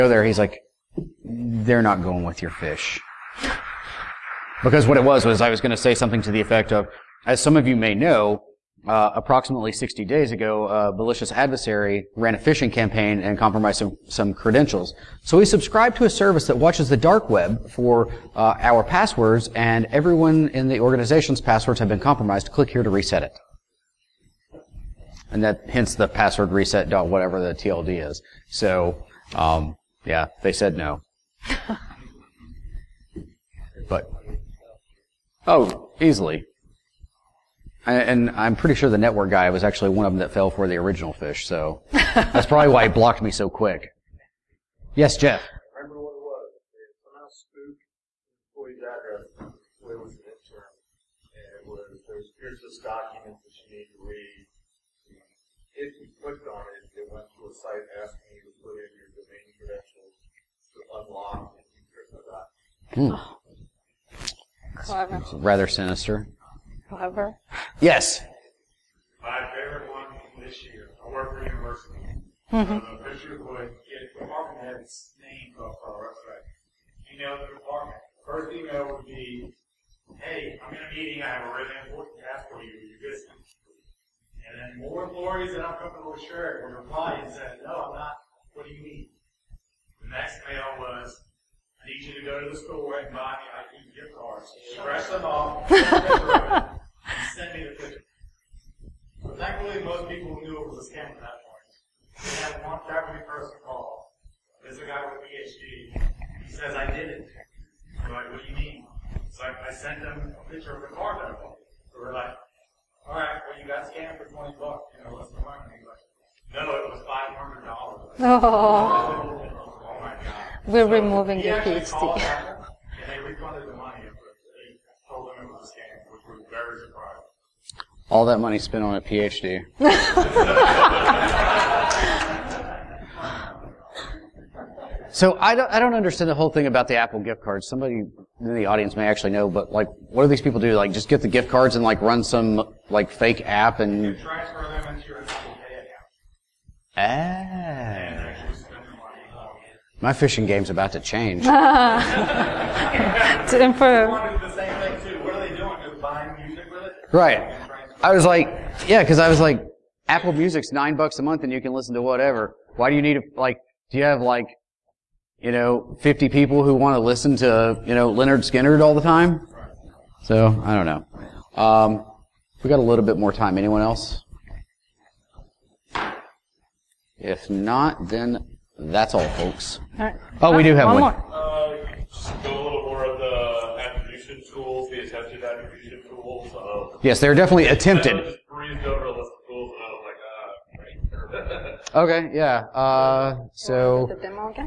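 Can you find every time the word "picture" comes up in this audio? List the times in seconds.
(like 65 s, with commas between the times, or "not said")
73 s, 97 s, 110 s.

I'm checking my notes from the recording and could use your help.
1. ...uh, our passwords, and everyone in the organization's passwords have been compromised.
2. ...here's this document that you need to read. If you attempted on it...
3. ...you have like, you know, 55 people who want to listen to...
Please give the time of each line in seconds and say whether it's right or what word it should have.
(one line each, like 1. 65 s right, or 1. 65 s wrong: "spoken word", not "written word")
1. 18 s right
2. 52 s wrong: "clicked", not "attempted"
3. 163 s wrong: "50", not "55".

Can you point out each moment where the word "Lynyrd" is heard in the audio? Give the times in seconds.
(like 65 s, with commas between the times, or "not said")
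168 s.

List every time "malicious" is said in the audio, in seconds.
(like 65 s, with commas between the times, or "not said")
10 s.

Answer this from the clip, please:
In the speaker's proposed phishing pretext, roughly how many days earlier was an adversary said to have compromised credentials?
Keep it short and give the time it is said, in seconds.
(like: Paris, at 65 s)
60 days, at 9 s.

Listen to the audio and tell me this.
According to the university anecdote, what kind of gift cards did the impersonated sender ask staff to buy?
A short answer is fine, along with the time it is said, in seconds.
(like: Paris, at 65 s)
iTunes gift cards, at 93 s.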